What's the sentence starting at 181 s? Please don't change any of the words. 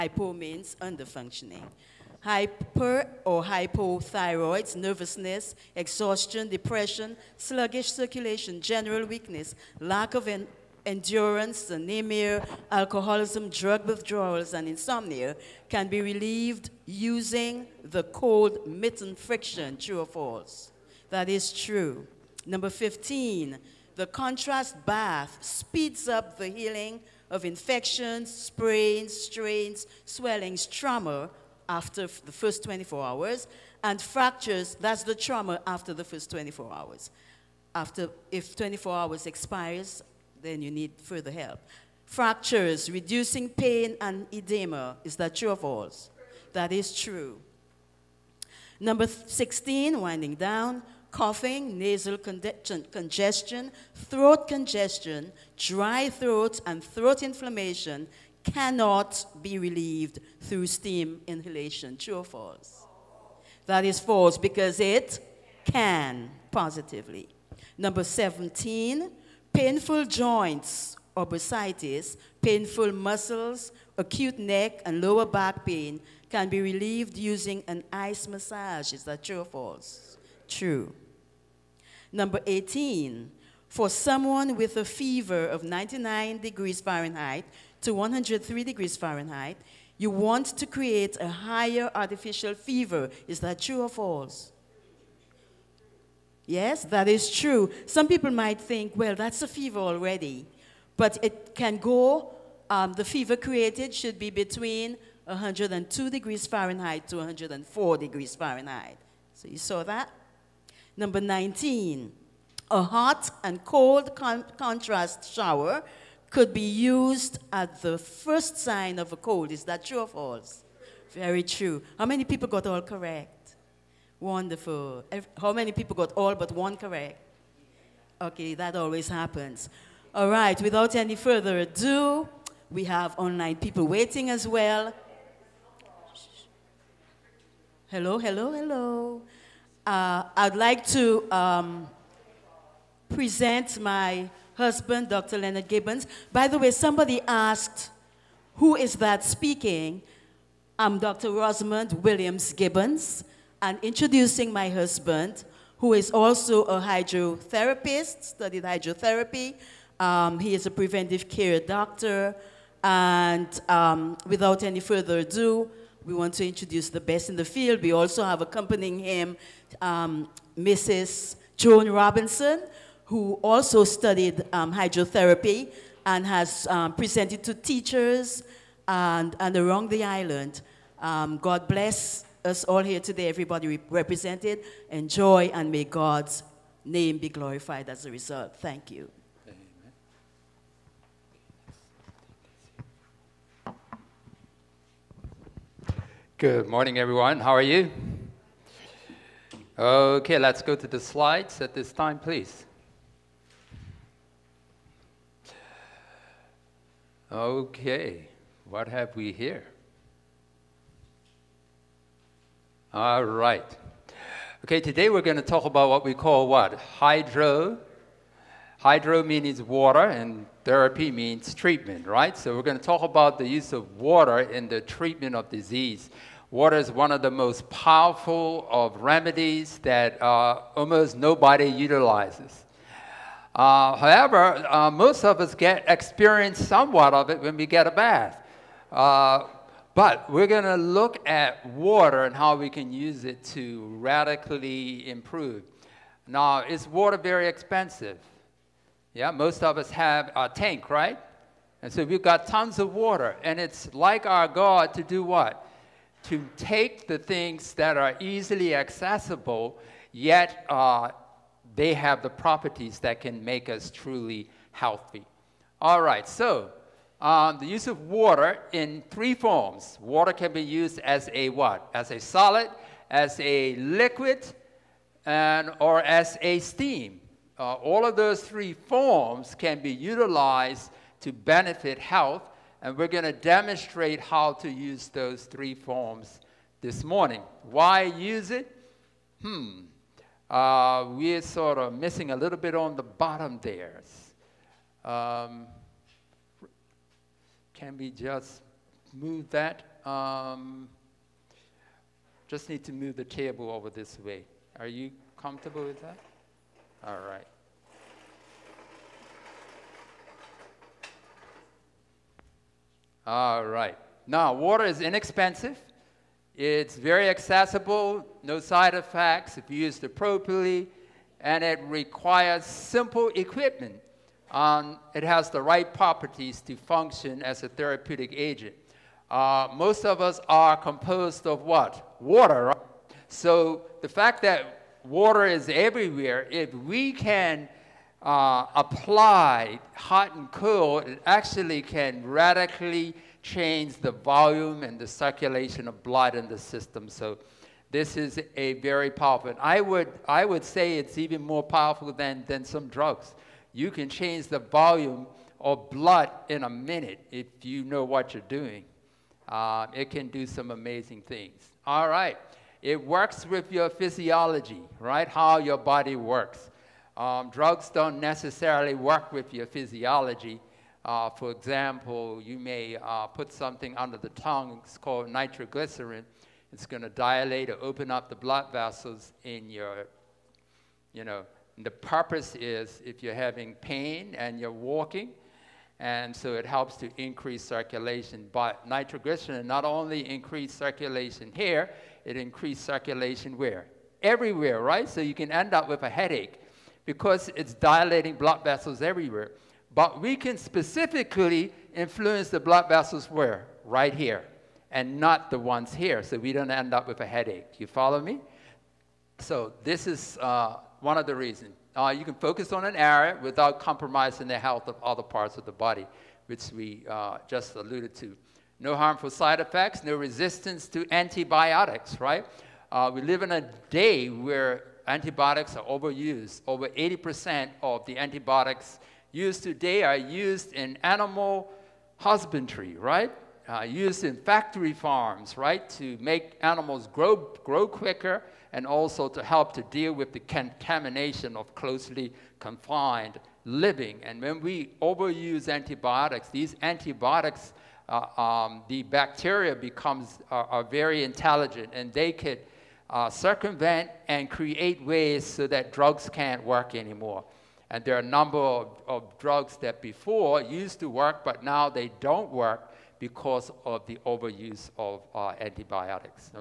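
Um, God bless us all here today, everybody re represented.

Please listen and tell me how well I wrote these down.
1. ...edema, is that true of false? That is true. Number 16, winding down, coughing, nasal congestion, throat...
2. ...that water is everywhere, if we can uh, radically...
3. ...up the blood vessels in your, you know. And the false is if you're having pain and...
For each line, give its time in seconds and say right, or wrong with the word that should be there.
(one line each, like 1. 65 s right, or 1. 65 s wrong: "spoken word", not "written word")
1. 44 s right
2. 334 s wrong: "apply", not "radically"
3. 378 s wrong: "purpose", not "false".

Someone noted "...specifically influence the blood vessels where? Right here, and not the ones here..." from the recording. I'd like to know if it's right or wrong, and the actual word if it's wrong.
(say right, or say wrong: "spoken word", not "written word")
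right.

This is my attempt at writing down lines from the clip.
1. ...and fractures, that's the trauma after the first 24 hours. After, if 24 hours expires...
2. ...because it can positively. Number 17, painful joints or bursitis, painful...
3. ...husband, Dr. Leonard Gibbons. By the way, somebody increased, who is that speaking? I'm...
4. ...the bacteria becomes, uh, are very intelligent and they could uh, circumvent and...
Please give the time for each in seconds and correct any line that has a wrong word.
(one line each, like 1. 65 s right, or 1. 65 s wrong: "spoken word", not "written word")
1. 33 s right
2. 64 s right
3. 144 s wrong: "asked", not "increased"
4. 448 s right.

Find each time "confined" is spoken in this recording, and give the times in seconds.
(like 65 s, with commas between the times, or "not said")
442 s.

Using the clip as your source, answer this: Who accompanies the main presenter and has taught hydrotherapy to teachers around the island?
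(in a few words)
Joan Robinson.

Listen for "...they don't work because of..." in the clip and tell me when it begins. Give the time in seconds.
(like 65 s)
461 s.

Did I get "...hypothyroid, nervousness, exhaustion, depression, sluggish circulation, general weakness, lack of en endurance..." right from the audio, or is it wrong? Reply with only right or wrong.
right.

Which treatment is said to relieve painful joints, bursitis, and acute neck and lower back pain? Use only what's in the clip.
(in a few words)
Ice massage.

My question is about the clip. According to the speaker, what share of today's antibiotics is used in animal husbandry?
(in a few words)
Over 80%.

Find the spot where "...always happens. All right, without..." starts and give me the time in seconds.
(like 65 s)
128 s.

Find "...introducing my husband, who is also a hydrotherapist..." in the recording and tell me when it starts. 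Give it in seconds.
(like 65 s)
153 s.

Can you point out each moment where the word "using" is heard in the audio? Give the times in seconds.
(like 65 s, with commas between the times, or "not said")
16 s, 77 s.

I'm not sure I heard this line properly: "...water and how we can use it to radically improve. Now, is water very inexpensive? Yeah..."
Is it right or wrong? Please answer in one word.
wrong.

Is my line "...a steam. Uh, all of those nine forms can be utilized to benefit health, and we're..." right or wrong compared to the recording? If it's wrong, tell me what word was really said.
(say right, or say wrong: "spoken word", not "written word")
wrong: "three", not "nine".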